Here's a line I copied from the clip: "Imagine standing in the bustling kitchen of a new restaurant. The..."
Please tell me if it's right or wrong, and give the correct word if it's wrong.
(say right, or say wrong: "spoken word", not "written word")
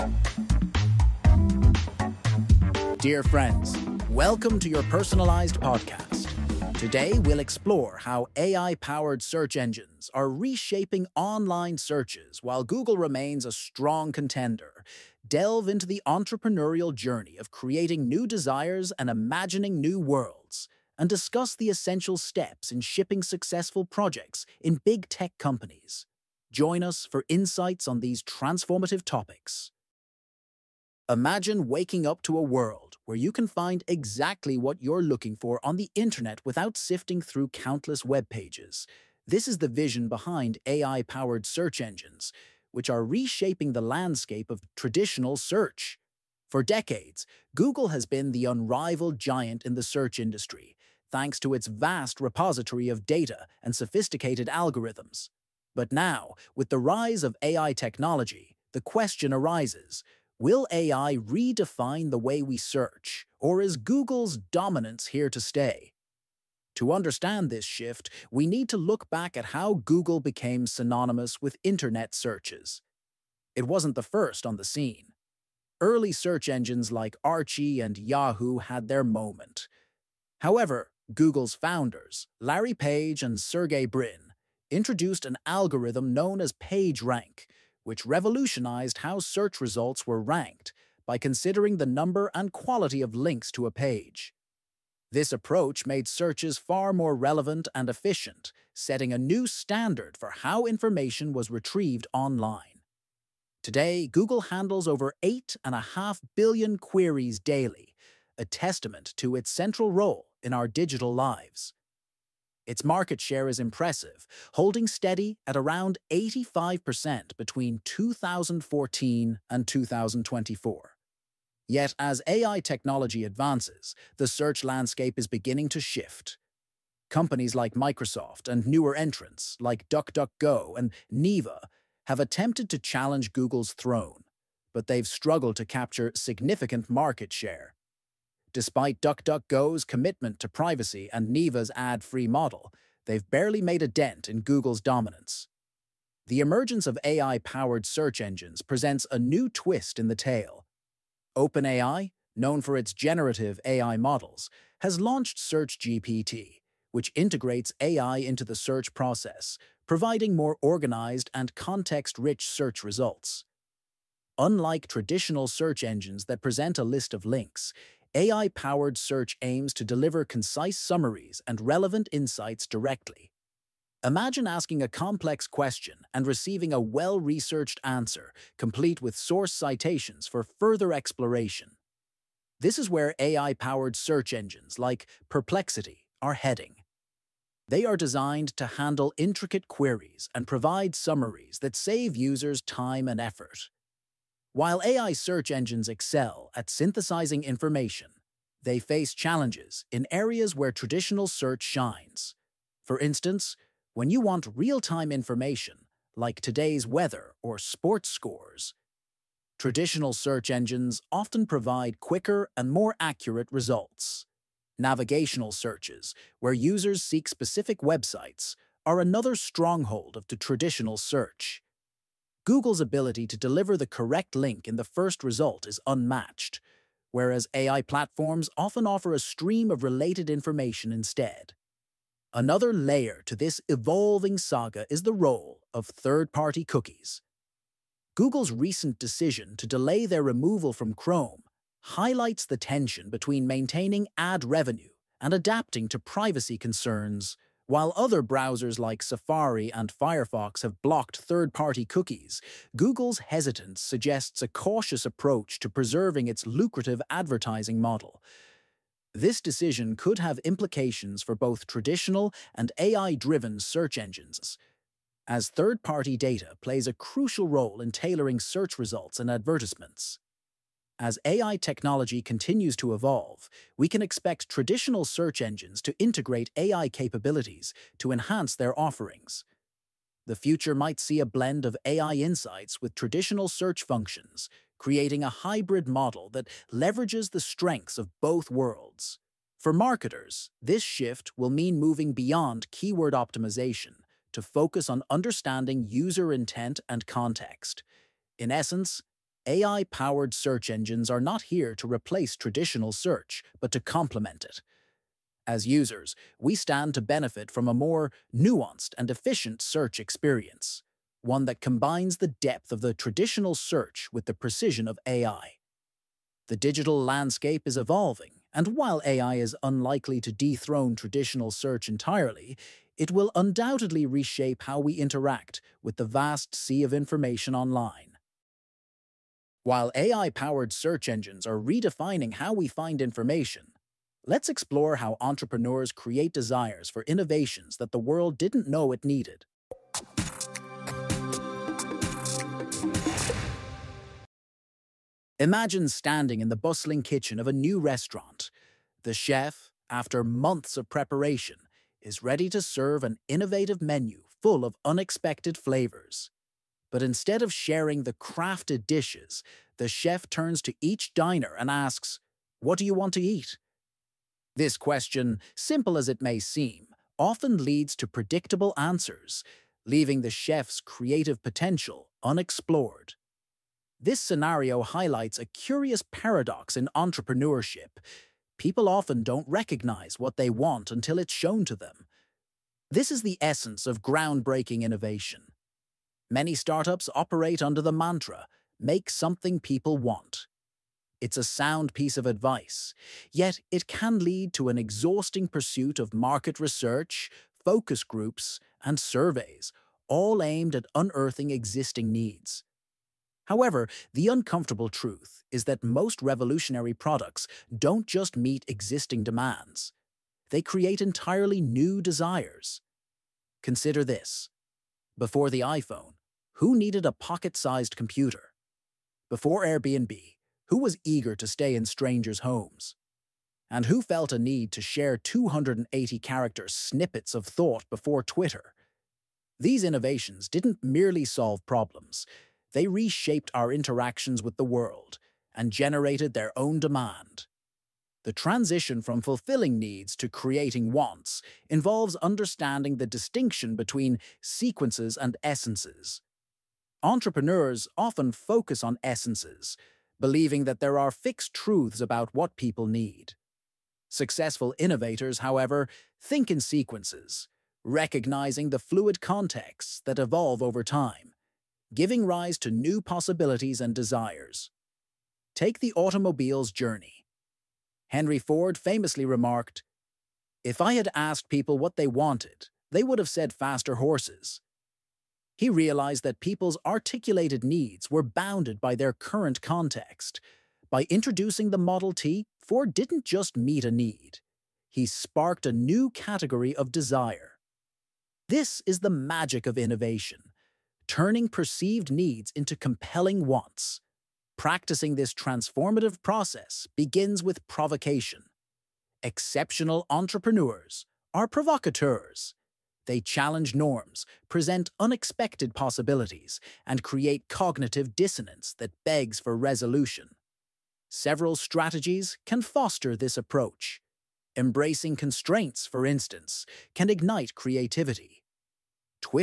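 right.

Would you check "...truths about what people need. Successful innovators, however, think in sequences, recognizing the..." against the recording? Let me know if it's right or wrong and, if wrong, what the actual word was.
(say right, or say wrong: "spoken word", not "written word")
right.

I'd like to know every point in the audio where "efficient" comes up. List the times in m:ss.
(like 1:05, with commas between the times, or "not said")
1:37, 5:09.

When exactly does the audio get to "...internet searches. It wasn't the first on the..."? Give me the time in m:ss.
1:11.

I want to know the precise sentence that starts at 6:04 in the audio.
This question, simple as it may seem, often leads to predictable answers, leaving the chef's creative potential unexplored.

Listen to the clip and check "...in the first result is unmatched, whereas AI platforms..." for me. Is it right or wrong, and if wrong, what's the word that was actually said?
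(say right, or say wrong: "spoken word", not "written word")
right.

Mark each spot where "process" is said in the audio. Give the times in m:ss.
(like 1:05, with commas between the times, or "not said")
2:38, 8:16.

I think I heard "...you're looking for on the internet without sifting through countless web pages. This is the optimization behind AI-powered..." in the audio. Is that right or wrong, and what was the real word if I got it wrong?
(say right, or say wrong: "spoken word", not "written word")
wrong: "vision", not "optimization".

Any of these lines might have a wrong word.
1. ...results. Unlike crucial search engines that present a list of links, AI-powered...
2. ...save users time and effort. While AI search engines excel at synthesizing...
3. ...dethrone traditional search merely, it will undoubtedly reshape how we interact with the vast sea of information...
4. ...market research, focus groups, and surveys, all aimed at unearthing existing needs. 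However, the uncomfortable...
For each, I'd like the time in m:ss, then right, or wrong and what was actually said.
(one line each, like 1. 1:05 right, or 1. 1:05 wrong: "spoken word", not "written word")
1. 2:42 wrong: "traditional", not "crucial"
2. 3:11 right
3. 5:20 wrong: "entirely", not "merely"
4. 6:36 right.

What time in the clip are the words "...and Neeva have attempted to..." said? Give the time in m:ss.
2:10.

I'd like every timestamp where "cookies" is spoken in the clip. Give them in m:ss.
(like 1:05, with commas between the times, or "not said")
3:56, 4:11.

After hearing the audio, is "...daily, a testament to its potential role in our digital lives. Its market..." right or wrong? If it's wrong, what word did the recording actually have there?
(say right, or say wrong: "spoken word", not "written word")
wrong: "central", not "potential".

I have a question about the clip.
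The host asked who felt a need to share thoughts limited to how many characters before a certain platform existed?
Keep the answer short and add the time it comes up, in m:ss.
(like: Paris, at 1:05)
280, at 7:05.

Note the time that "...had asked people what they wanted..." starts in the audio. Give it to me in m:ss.
7:50.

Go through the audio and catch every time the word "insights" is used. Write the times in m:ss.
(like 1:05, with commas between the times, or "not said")
0:27, 2:52, 4:42.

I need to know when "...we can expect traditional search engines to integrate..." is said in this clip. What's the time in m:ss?
4:33.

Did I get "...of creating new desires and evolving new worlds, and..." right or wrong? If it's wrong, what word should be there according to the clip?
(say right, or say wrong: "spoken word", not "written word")
wrong: "imagining", not "evolving".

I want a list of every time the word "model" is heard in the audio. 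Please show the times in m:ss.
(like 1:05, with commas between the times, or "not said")
2:22, 2:33, 4:17, 4:45, 8:01.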